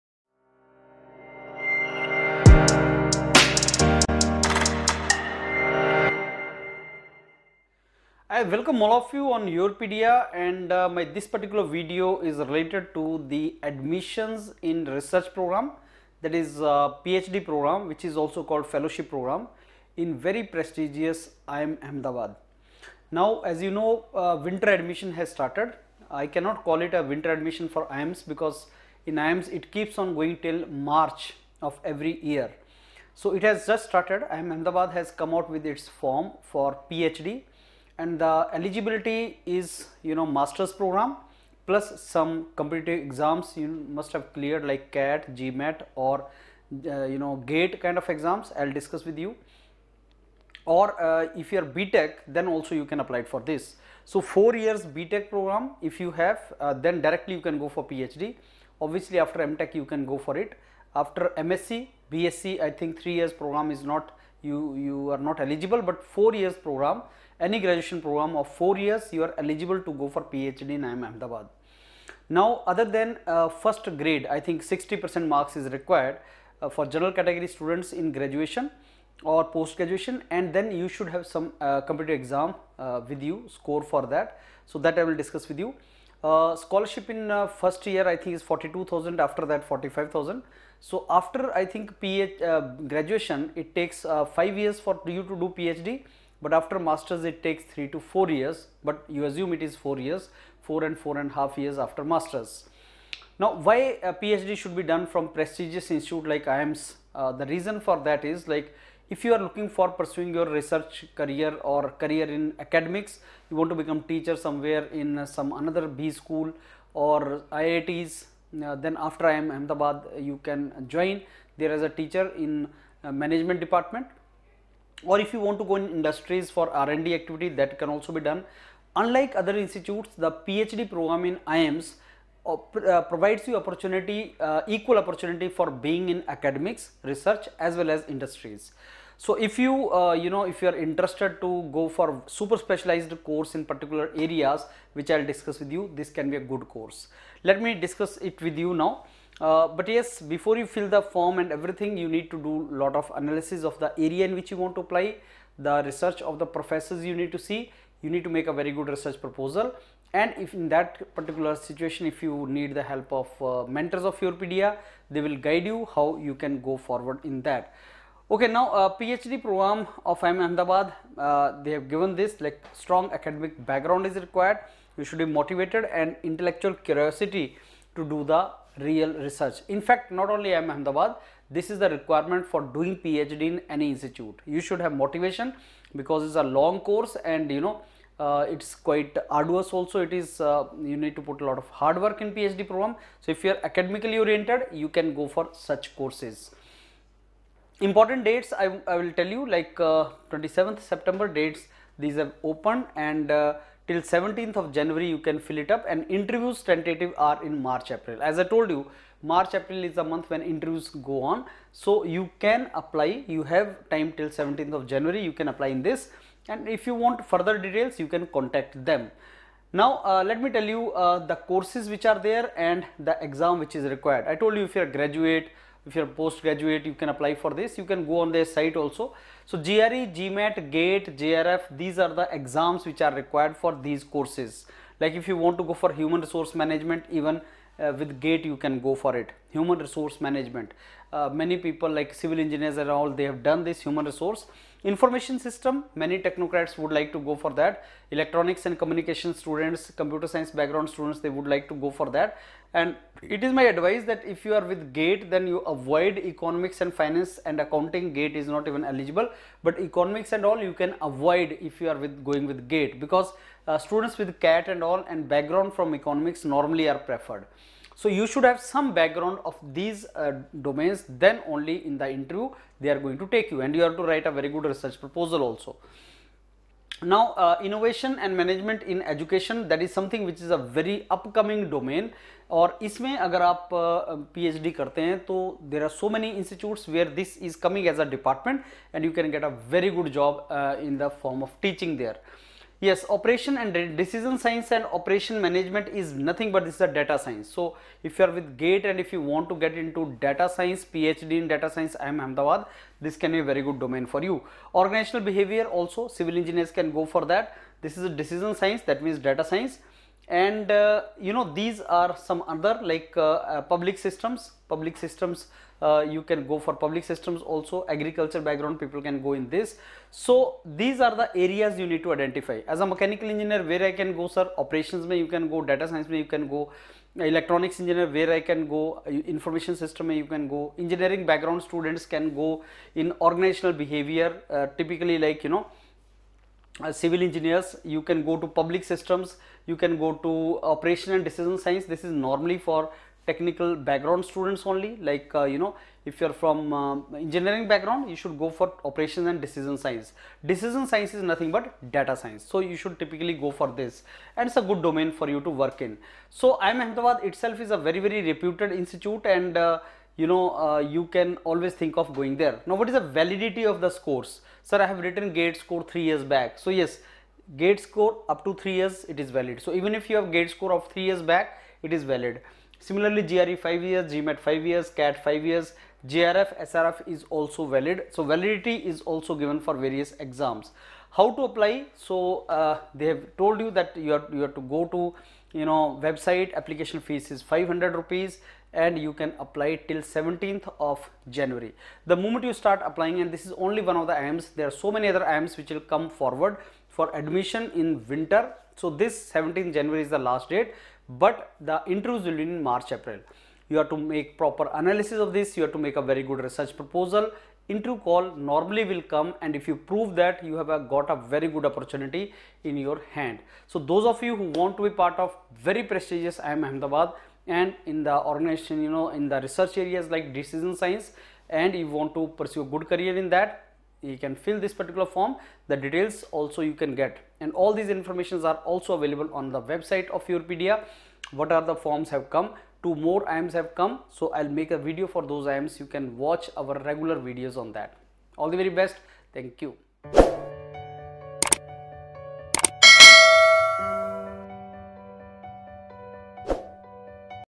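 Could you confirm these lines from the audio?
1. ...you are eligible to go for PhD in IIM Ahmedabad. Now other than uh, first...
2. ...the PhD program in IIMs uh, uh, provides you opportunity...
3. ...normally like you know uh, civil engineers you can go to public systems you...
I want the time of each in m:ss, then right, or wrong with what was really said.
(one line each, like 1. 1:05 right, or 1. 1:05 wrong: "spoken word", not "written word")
1. 1:09 right
2. 2:10 right
3. 5:34 wrong: "typically", not "normally".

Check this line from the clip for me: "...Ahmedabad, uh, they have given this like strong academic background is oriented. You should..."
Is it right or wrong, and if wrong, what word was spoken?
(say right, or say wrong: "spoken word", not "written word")
wrong: "required", not "oriented".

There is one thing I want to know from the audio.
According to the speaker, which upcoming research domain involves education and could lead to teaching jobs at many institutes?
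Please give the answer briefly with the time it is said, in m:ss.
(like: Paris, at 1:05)
Innovation and management in education, at 4:37.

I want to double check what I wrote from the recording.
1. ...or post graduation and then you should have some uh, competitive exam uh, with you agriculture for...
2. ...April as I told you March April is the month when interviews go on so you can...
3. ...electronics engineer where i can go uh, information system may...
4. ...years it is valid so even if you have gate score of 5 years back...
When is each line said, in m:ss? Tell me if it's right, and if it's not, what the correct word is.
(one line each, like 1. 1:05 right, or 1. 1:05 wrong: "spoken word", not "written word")
1. 1:19 wrong: "score", not "agriculture"
2. 3:27 right
3. 5:27 right
4. 6:08 wrong: "3", not "5".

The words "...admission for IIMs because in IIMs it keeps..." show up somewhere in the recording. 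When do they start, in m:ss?
0:27.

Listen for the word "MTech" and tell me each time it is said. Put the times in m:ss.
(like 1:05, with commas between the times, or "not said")
0:59.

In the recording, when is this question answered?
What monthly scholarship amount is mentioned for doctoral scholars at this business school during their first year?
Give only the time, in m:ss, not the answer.
1:28.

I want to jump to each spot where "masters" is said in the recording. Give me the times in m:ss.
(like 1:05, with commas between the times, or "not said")
0:40, 1:36, 1:42.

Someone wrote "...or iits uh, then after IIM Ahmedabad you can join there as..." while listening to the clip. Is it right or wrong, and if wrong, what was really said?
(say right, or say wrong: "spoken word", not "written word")
right.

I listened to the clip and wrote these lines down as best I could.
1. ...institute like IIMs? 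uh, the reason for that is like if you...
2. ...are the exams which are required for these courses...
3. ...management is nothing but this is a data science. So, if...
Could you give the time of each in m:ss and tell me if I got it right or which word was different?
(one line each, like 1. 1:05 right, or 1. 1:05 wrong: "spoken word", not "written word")
1. 1:45 right
2. 3:51 right
3. 4:55 right.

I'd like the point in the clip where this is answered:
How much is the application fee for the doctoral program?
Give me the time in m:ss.
6:27.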